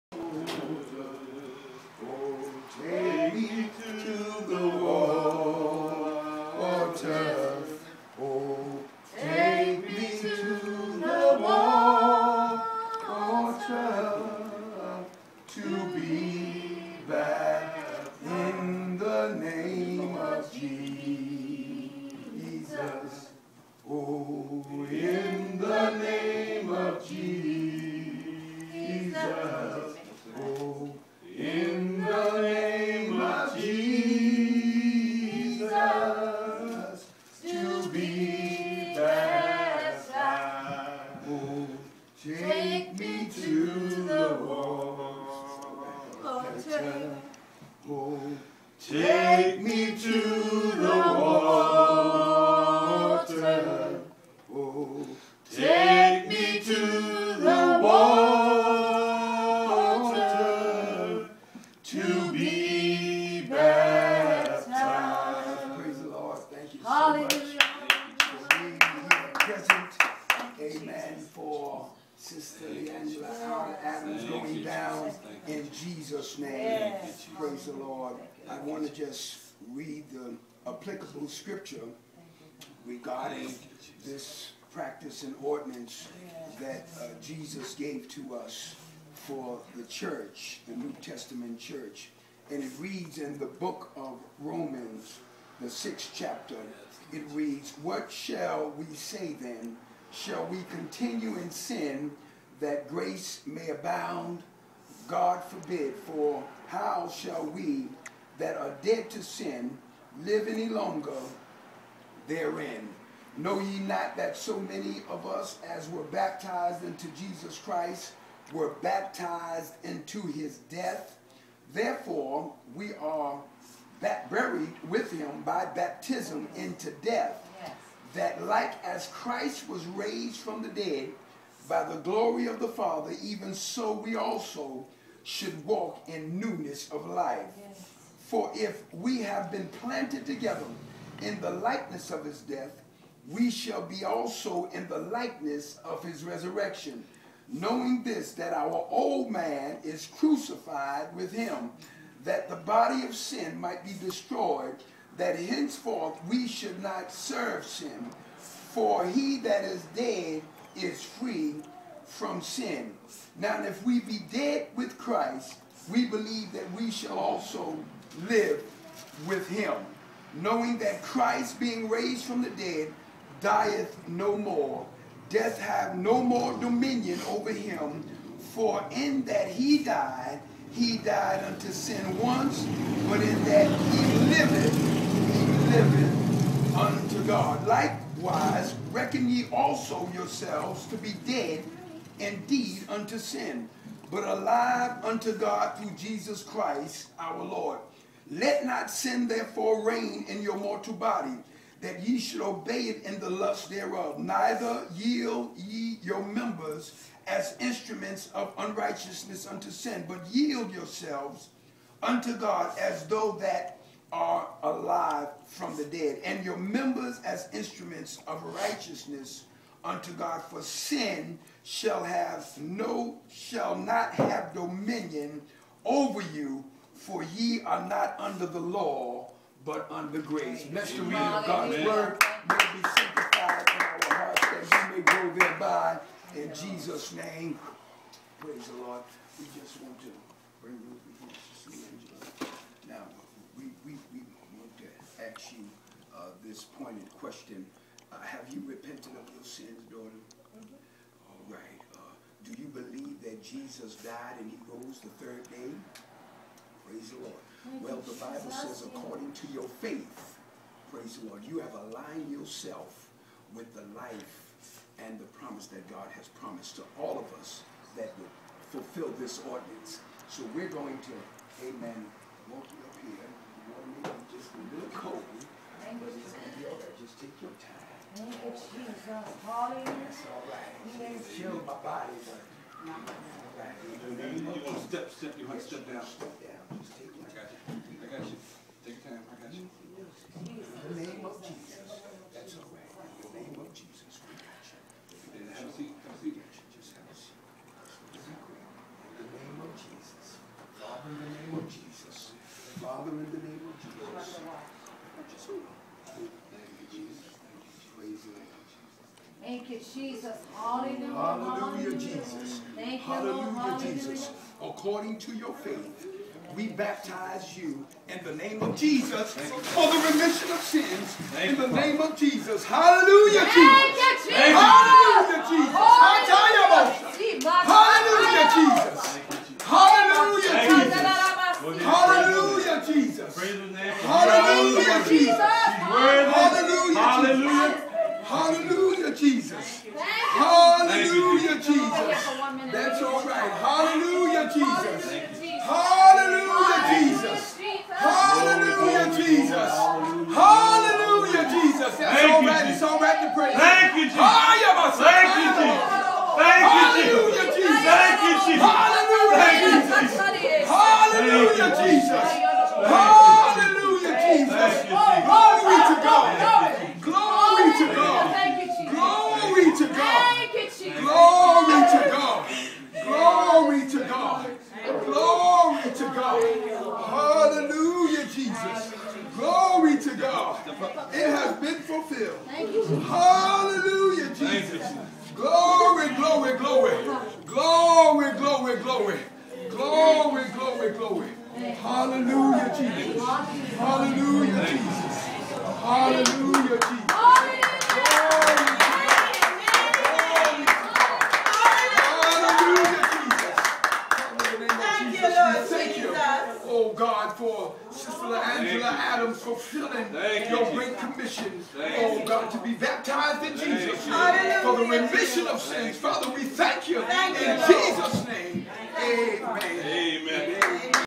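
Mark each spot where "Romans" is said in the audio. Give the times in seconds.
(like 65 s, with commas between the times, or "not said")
94 s.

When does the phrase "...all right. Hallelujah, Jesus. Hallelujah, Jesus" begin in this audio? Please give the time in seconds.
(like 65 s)
343 s.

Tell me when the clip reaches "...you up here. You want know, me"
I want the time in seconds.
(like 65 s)
272 s.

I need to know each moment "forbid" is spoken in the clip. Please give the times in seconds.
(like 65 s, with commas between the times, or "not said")
105 s.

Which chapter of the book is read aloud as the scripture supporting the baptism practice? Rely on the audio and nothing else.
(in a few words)
sixth.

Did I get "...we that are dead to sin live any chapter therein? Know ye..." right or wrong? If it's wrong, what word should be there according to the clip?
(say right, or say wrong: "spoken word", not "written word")
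wrong: "longer", not "chapter".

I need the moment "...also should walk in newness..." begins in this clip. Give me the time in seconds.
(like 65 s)
134 s.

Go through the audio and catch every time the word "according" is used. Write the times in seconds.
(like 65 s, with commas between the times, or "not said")
258 s, 314 s.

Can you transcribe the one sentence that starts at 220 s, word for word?
For sin shall have no, shall not have dominion over you, for ye are not under the law, but under grace.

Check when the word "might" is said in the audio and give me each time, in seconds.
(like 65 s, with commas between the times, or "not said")
153 s.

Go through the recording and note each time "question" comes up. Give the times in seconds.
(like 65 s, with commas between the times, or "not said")
247 s.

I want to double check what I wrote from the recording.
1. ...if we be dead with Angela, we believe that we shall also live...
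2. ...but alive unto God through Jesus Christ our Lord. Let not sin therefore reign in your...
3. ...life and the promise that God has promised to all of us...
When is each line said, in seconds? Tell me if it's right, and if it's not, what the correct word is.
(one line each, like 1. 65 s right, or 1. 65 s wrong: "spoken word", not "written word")
1. 163 s wrong: "Christ", not "Angela"
2. 194 s right
3. 263 s right.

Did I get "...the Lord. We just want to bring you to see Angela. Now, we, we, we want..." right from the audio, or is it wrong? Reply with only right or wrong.
right.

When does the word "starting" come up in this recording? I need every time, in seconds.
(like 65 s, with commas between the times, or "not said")
not said.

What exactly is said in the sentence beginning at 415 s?
Father, we thank you in Jesus' name.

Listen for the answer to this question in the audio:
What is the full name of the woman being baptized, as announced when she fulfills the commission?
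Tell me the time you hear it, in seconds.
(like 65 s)
408 s.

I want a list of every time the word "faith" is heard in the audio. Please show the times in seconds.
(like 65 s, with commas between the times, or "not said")
259 s, 315 s.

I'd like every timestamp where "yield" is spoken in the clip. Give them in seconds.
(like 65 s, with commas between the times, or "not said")
204 s, 210 s.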